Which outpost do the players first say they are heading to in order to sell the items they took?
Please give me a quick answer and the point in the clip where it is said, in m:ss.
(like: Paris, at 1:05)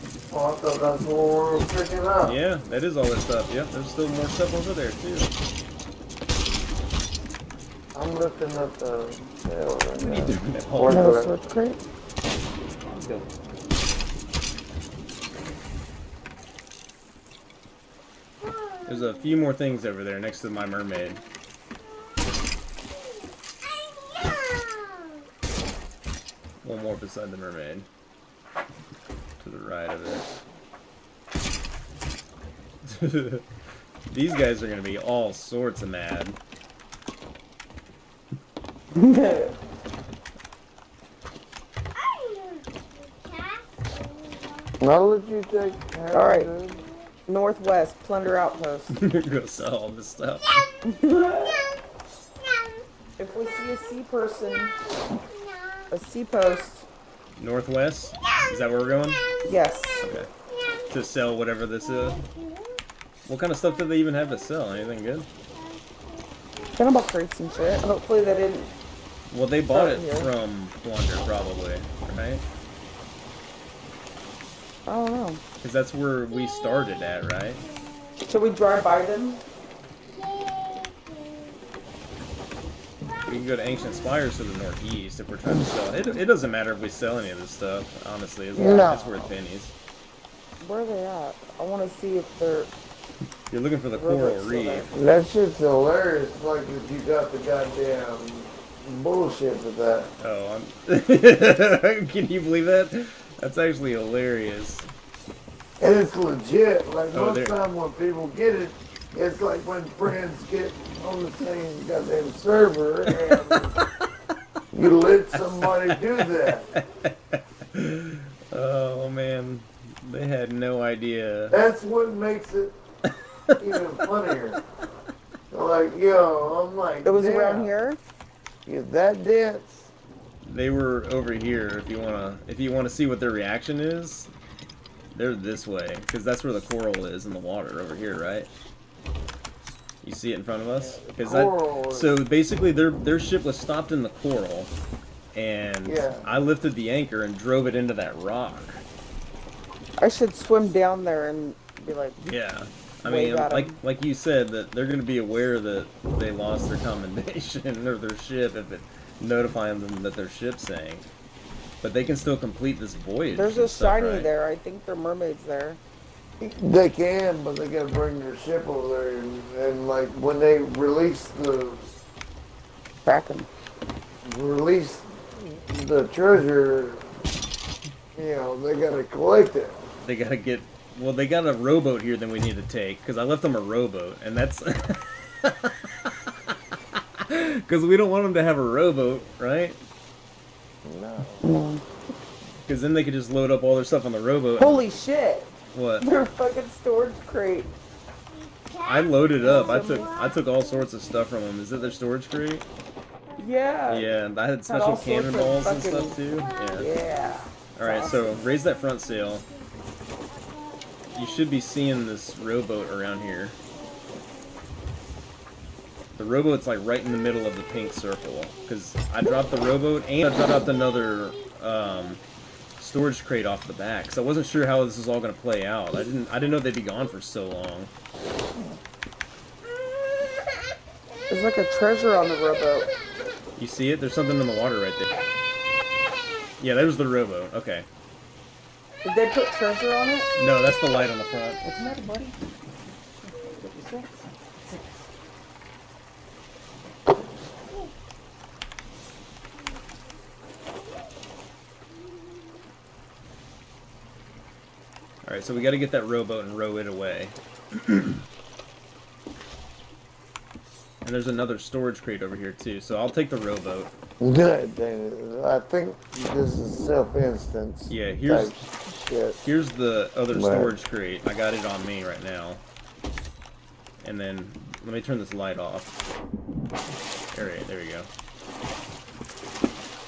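Northwest plunder outpost, at 0:47.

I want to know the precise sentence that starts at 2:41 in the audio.
But they can still complete this voyage.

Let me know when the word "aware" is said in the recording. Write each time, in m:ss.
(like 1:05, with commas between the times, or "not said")
2:35.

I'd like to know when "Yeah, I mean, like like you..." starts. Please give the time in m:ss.
2:32.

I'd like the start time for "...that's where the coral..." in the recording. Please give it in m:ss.
2:16.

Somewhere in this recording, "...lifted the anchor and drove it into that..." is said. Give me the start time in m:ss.
2:26.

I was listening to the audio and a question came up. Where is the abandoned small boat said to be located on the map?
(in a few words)
middle of the pink circle.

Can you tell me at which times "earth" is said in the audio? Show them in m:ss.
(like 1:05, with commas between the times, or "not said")
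not said.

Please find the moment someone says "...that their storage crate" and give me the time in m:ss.
3:21.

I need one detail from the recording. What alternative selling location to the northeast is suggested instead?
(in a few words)
Ancient Spires.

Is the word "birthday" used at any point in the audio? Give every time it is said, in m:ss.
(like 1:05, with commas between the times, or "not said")
not said.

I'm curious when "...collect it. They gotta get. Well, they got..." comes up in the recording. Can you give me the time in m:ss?
2:59.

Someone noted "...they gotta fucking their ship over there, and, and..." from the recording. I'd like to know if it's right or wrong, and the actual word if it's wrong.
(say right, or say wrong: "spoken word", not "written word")
wrong: "bring", not "fucking".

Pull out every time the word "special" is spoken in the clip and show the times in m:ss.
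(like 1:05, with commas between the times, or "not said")
3:24.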